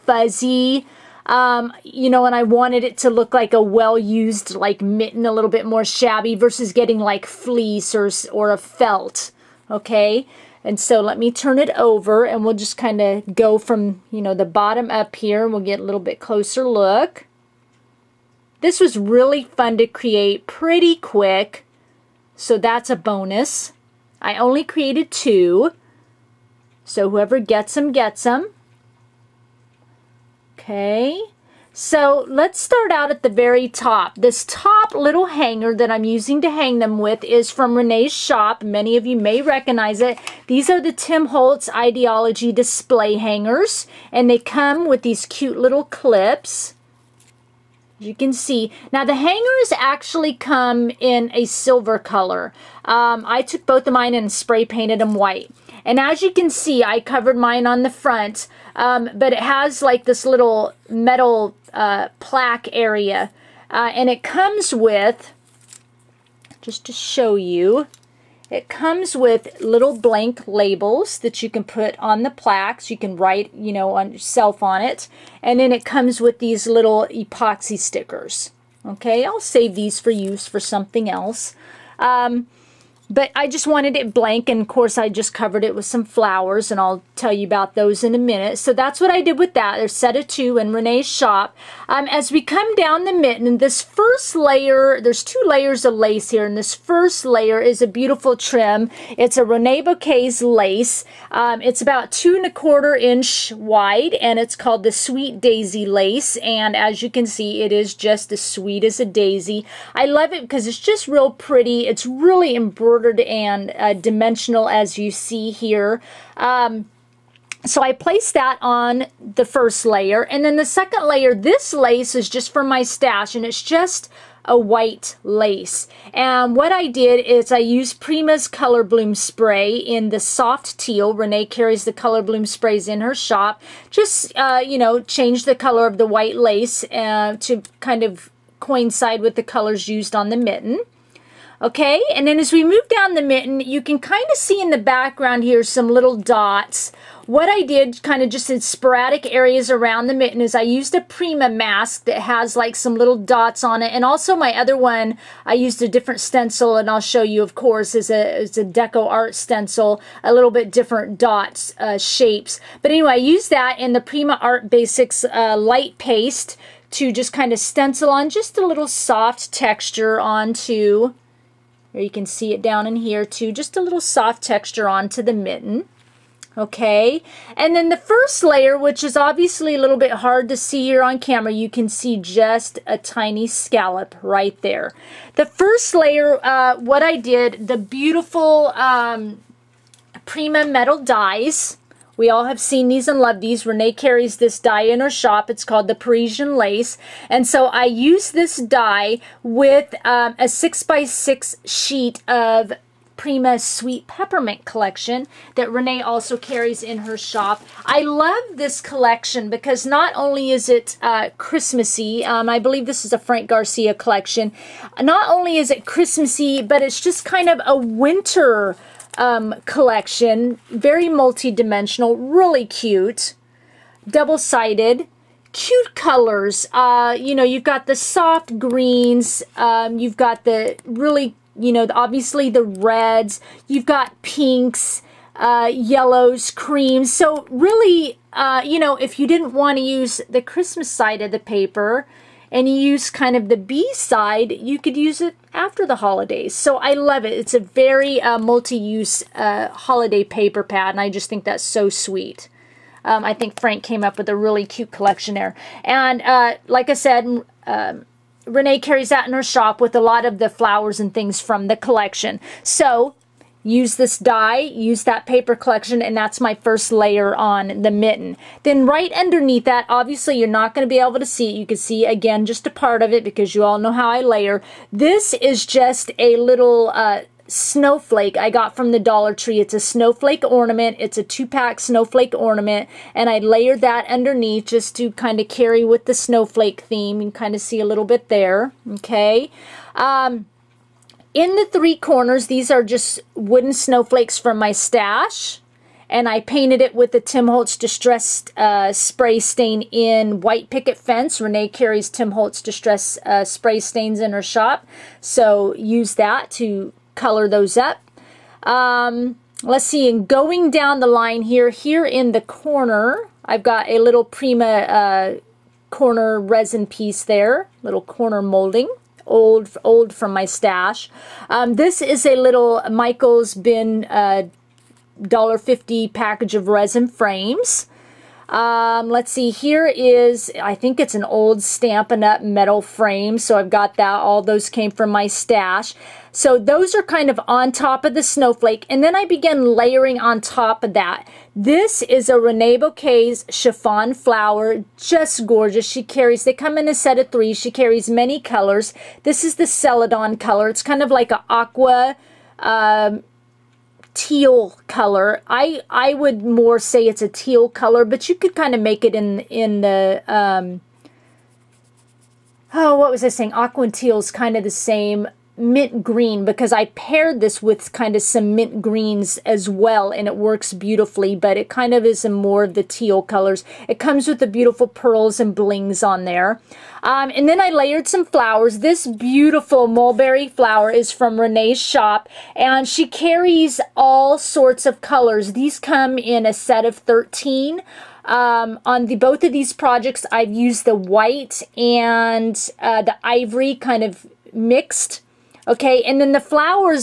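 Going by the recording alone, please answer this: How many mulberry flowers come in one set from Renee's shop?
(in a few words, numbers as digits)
13.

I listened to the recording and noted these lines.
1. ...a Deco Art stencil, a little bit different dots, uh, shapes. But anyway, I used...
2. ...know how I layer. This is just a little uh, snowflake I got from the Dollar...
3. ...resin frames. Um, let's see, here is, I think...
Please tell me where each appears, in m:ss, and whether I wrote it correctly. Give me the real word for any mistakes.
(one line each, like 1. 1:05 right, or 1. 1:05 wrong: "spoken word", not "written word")
1. 2:38 right
2. 4:33 right
3. 5:26 right.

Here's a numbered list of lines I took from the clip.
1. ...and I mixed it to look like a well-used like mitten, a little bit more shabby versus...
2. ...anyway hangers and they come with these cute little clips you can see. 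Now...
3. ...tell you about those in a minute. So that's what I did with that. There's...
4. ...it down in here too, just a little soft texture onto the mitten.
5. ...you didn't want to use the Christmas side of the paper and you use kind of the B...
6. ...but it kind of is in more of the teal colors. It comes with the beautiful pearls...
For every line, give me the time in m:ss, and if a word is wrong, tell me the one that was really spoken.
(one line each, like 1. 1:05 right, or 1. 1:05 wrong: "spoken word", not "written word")
1. 0:02 wrong: "wanted", not "mixed"
2. 0:42 wrong: "display", not "anyway"
3. 1:27 right
4. 2:52 right
5. 3:59 right
6. 6:11 right.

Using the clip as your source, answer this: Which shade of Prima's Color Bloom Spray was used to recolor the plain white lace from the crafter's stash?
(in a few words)
soft teal.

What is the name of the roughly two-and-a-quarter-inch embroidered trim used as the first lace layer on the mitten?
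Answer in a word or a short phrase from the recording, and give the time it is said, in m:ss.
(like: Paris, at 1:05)
Sweet Daisy lace, at 1:44.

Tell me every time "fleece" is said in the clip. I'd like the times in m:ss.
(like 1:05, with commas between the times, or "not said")
0:07.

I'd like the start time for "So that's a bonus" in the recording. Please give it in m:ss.
0:22.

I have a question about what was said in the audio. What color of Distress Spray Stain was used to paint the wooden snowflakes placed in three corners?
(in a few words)
White Picket Fence.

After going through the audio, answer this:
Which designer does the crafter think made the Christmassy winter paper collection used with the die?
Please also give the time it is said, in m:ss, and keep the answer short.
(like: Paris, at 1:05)
Frank Garcia, at 3:33.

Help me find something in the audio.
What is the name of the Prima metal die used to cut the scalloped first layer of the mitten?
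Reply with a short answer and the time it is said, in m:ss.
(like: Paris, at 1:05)
Parisian Lace, at 3:15.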